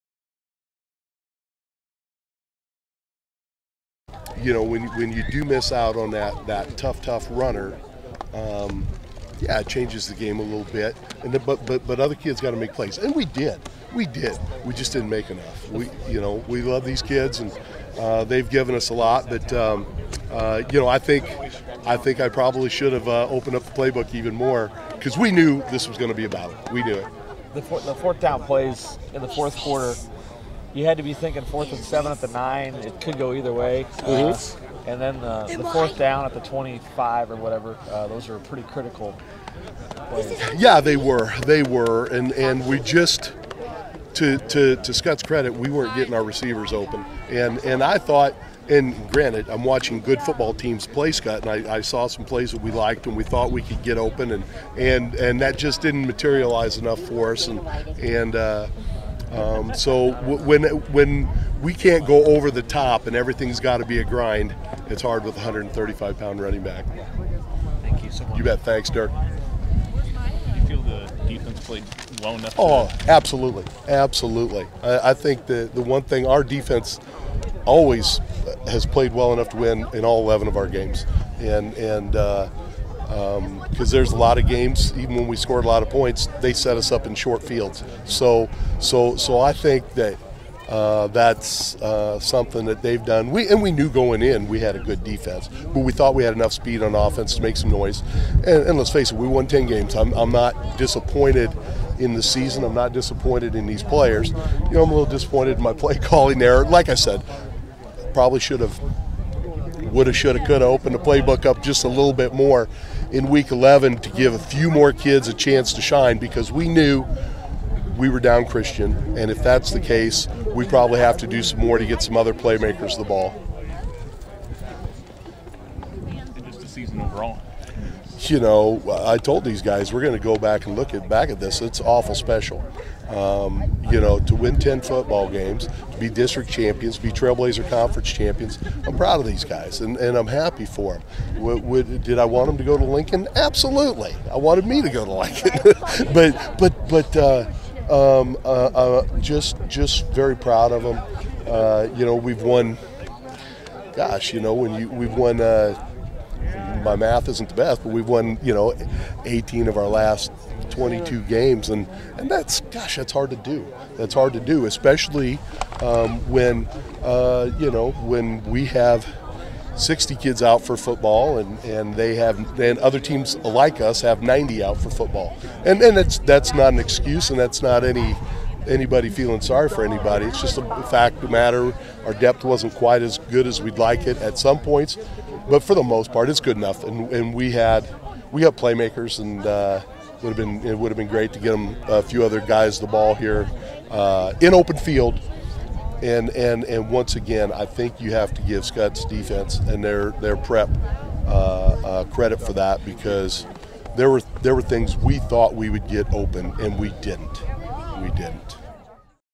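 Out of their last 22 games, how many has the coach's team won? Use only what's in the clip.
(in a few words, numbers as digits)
18.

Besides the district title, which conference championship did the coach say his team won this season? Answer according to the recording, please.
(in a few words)
Trailblazer Conference.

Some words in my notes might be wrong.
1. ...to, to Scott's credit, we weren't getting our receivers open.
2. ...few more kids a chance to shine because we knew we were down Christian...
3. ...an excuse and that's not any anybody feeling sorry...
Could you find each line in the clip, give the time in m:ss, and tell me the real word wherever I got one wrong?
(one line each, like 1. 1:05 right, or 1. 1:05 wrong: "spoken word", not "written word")
1. 0:44 right
2. 1:54 right
3. 2:56 right.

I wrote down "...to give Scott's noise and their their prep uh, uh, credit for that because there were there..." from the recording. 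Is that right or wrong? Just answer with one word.
wrong.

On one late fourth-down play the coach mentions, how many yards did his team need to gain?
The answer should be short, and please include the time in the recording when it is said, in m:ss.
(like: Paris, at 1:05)
7, at 0:31.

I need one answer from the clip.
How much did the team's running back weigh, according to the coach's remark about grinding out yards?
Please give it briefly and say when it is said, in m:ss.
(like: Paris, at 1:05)
135 pounds, at 1:05.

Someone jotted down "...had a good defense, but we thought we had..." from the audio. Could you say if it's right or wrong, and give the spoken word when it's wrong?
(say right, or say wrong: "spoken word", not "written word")
right.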